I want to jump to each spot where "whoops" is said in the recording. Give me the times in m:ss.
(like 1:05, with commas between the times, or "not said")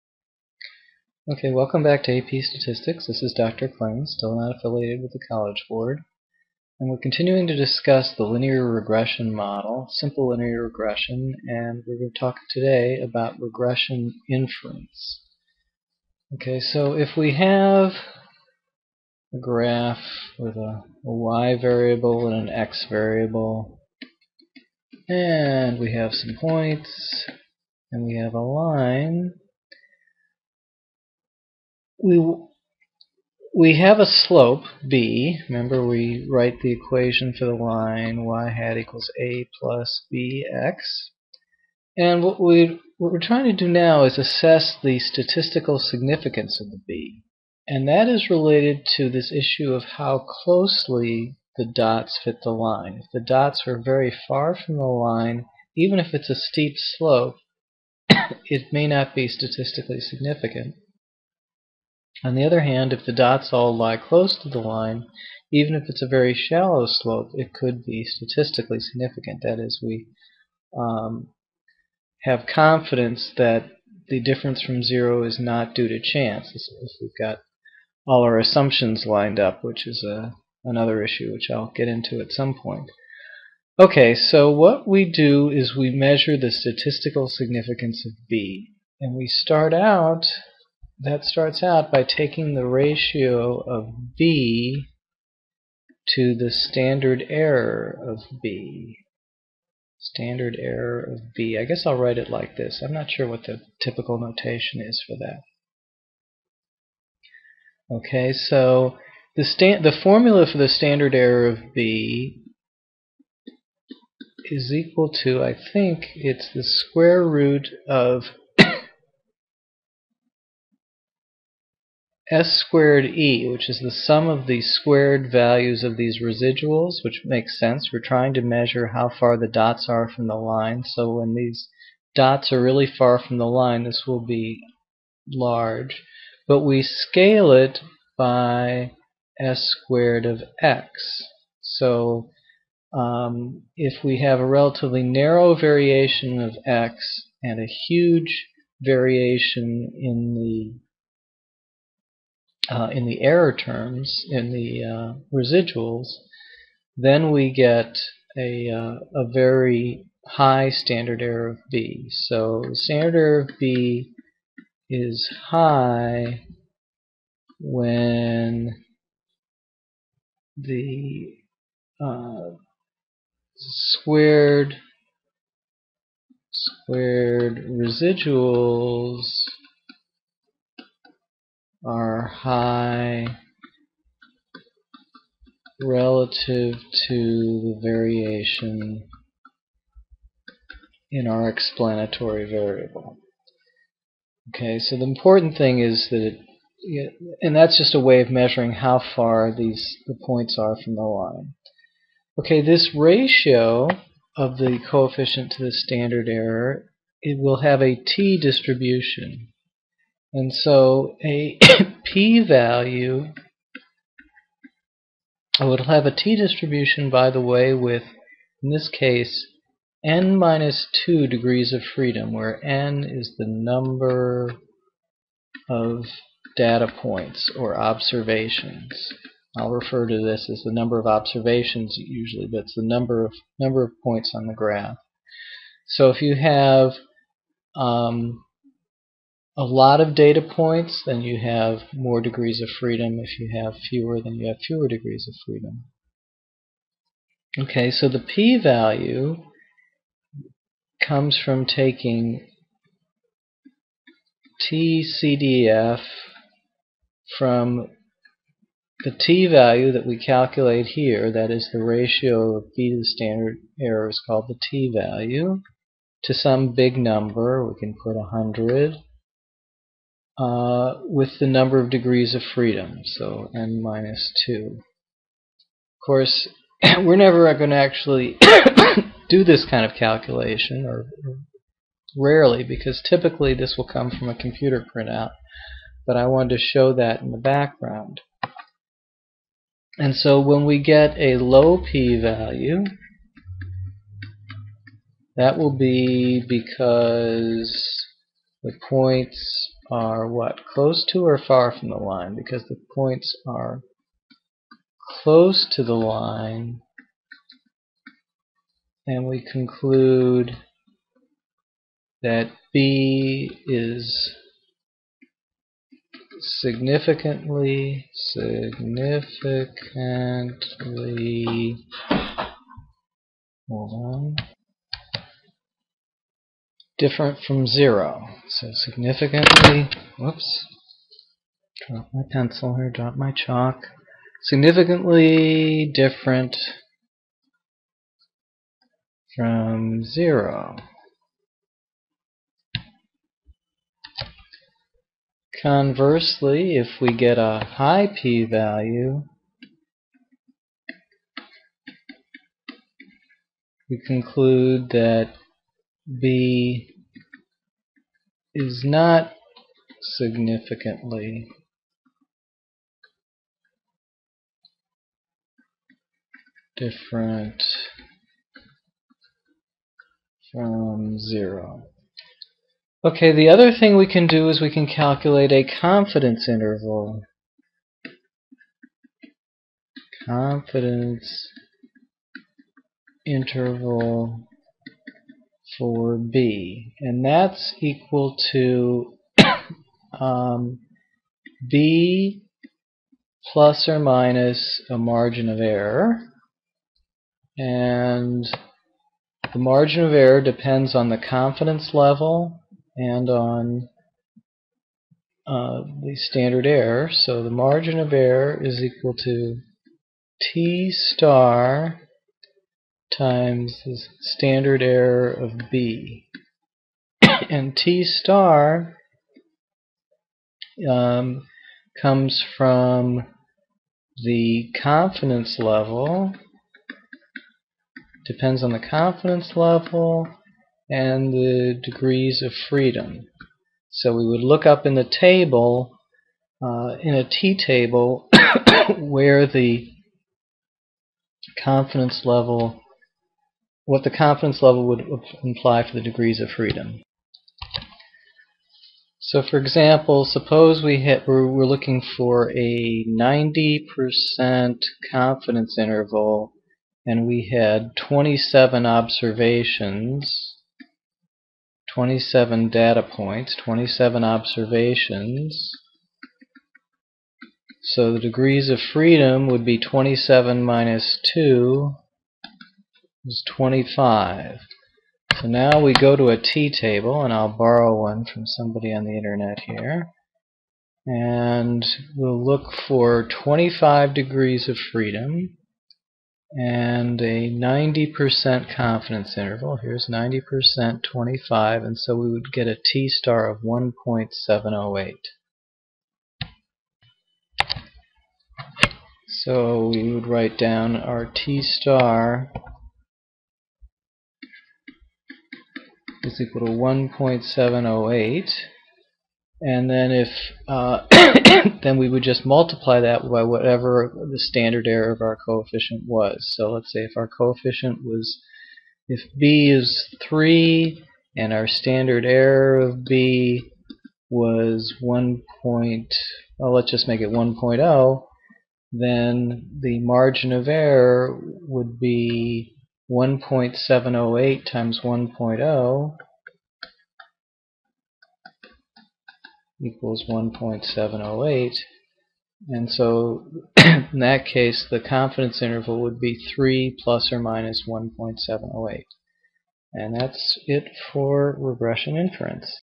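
5:30.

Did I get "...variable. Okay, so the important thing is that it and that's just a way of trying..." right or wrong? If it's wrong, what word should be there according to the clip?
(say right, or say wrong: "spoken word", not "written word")
wrong: "measuring", not "trying".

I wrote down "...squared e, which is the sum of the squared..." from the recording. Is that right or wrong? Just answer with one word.
right.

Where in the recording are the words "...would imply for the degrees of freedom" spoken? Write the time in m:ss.
7:24.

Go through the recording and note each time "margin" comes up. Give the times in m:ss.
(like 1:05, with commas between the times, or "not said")
6:34, 6:39, 6:47, 8:49.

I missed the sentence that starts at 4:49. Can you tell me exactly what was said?
And so when we get a low p-value, that will be because the points are what?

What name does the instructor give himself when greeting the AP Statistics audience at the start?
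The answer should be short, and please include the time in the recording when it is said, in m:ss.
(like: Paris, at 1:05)
Dr. Kling, at 0:03.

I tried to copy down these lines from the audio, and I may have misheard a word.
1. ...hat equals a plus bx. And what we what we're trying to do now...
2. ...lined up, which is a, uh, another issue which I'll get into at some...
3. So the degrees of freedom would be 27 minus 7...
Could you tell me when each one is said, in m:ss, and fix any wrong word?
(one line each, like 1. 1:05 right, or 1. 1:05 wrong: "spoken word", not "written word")
1. 0:38 right
2. 1:19 right
3. 7:47 wrong: "2", not "7".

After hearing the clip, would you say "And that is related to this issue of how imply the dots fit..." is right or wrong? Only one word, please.
wrong.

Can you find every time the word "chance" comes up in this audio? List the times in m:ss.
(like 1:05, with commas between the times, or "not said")
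1:15.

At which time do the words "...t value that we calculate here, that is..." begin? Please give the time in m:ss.
4:19.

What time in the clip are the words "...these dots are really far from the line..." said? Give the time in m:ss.
2:11.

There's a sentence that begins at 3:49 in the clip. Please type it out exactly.
I'll refer to this as the number of observations usually, but it's the number of number of points on the graph.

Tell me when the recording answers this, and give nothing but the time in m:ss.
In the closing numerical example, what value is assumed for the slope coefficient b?
8:39.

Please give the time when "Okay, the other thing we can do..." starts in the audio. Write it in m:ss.
6:13.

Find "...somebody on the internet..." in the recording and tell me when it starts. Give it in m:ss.
7:58.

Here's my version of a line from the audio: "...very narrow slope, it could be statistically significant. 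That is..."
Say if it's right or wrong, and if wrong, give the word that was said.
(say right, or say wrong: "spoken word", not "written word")
wrong: "shallow", not "narrow".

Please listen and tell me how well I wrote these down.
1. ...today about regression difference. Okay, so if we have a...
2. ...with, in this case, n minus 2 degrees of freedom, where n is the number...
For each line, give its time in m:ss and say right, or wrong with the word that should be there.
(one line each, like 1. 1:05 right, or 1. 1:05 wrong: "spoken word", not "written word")
1. 0:12 wrong: "inference", not "difference"
2. 3:37 right.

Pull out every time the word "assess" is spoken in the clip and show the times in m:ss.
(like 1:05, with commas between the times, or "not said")
0:44.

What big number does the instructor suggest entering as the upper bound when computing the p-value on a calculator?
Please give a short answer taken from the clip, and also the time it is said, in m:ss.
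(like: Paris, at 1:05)
100, at 4:28.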